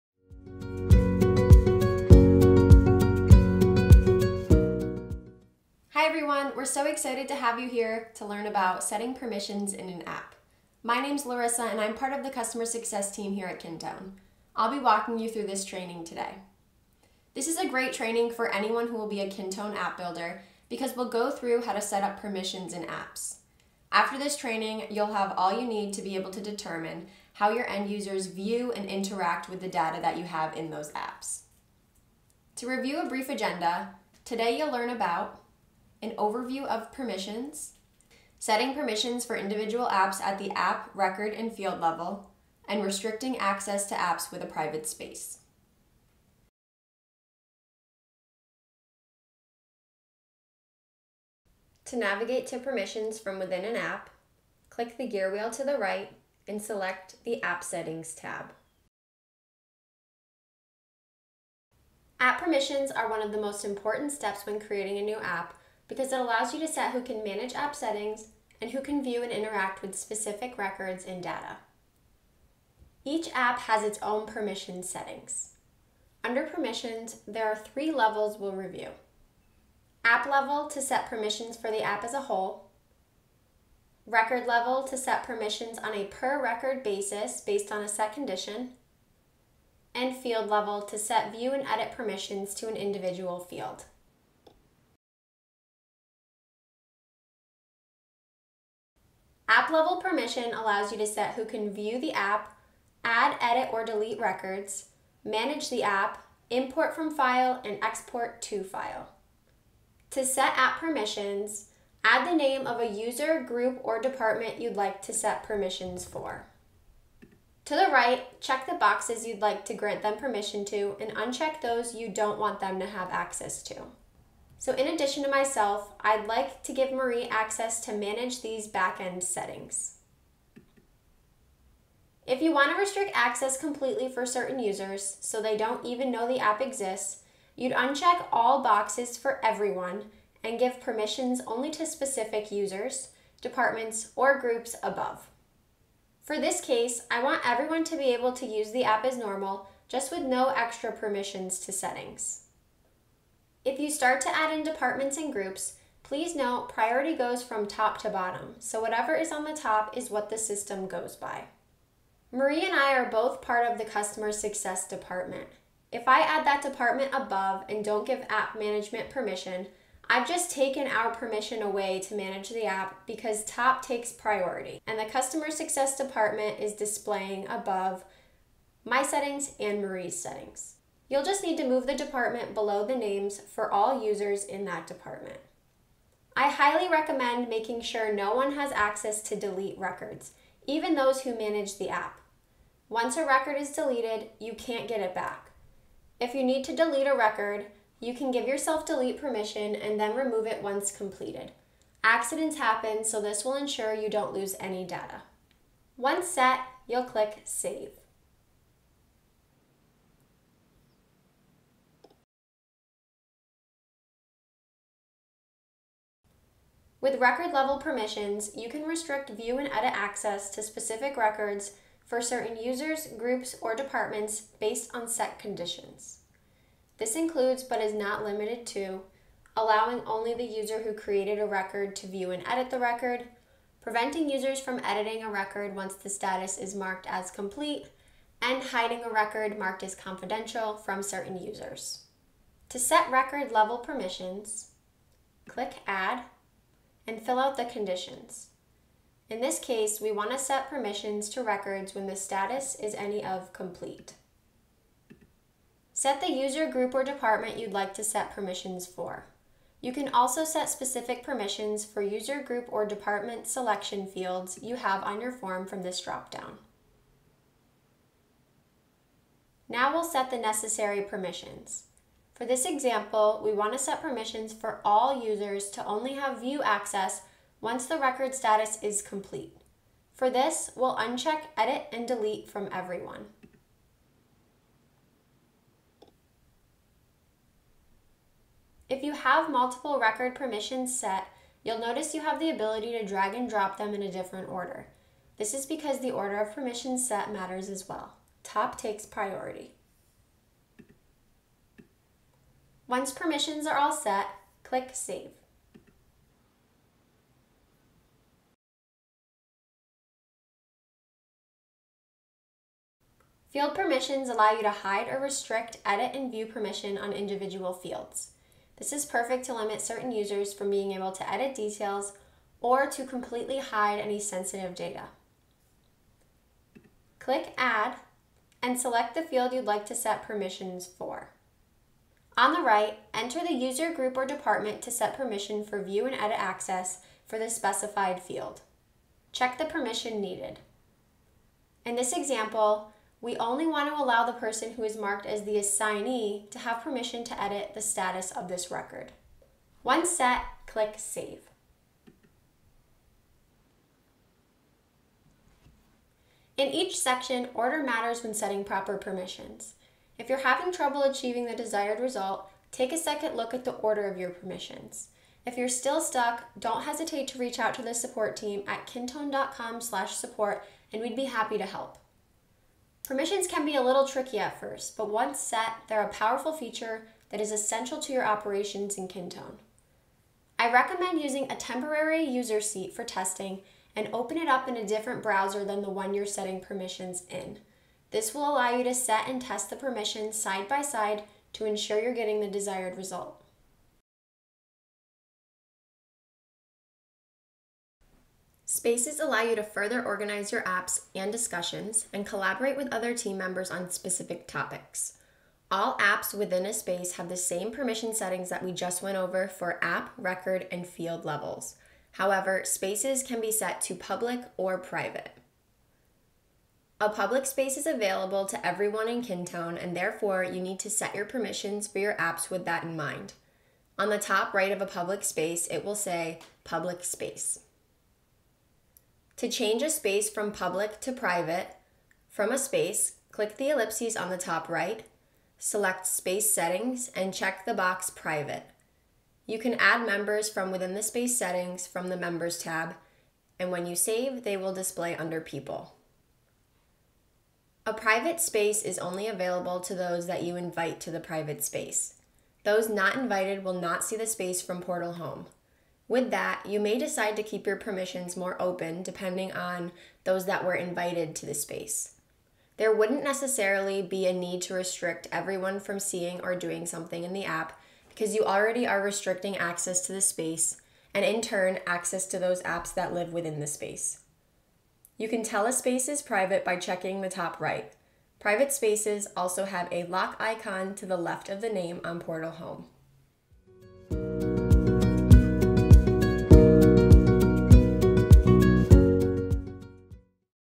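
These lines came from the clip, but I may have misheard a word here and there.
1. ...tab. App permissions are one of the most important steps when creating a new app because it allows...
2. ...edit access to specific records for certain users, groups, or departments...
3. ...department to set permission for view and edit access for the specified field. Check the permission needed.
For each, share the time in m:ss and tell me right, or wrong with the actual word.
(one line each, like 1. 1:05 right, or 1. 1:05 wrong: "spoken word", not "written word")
1. 0:58 right
2. 3:39 right
3. 5:34 right.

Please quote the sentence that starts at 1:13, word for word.
Each app has its own permission settings.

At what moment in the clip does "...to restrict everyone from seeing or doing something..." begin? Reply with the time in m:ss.
7:44.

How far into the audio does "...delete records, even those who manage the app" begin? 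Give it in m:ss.
3:09.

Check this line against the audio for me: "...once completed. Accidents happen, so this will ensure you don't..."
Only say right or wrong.
right.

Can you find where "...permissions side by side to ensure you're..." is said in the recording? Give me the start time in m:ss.
6:29.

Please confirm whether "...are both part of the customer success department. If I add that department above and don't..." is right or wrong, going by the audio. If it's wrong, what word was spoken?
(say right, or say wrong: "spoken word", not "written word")
right.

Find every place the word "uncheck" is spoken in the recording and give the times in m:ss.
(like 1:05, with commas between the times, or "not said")
2:01, 2:17, 4:40.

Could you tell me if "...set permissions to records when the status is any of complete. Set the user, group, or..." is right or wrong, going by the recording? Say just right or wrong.
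right.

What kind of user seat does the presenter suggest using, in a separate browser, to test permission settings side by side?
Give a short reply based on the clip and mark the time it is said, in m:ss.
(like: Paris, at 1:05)
Temporary user seat, at 6:21.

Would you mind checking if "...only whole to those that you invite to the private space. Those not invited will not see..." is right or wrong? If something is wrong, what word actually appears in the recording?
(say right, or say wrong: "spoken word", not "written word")
wrong: "available", not "whole".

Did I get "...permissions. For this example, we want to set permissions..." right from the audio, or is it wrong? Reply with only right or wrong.
right.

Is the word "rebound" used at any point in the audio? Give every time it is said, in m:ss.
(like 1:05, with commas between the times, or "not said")
not said.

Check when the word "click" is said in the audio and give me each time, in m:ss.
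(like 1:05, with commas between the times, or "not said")
0:54, 3:27, 4:05, 5:04, 5:27, 5:50, 7:13.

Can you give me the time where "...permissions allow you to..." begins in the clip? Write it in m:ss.
5:13.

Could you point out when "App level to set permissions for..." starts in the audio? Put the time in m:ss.
1:20.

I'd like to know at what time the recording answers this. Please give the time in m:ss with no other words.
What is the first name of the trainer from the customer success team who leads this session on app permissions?
0:11.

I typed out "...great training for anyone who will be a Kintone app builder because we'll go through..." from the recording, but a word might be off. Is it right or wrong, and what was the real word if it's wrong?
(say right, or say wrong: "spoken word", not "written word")
right.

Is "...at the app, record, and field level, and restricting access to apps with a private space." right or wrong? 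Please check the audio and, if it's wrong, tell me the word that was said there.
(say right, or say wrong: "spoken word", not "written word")
right.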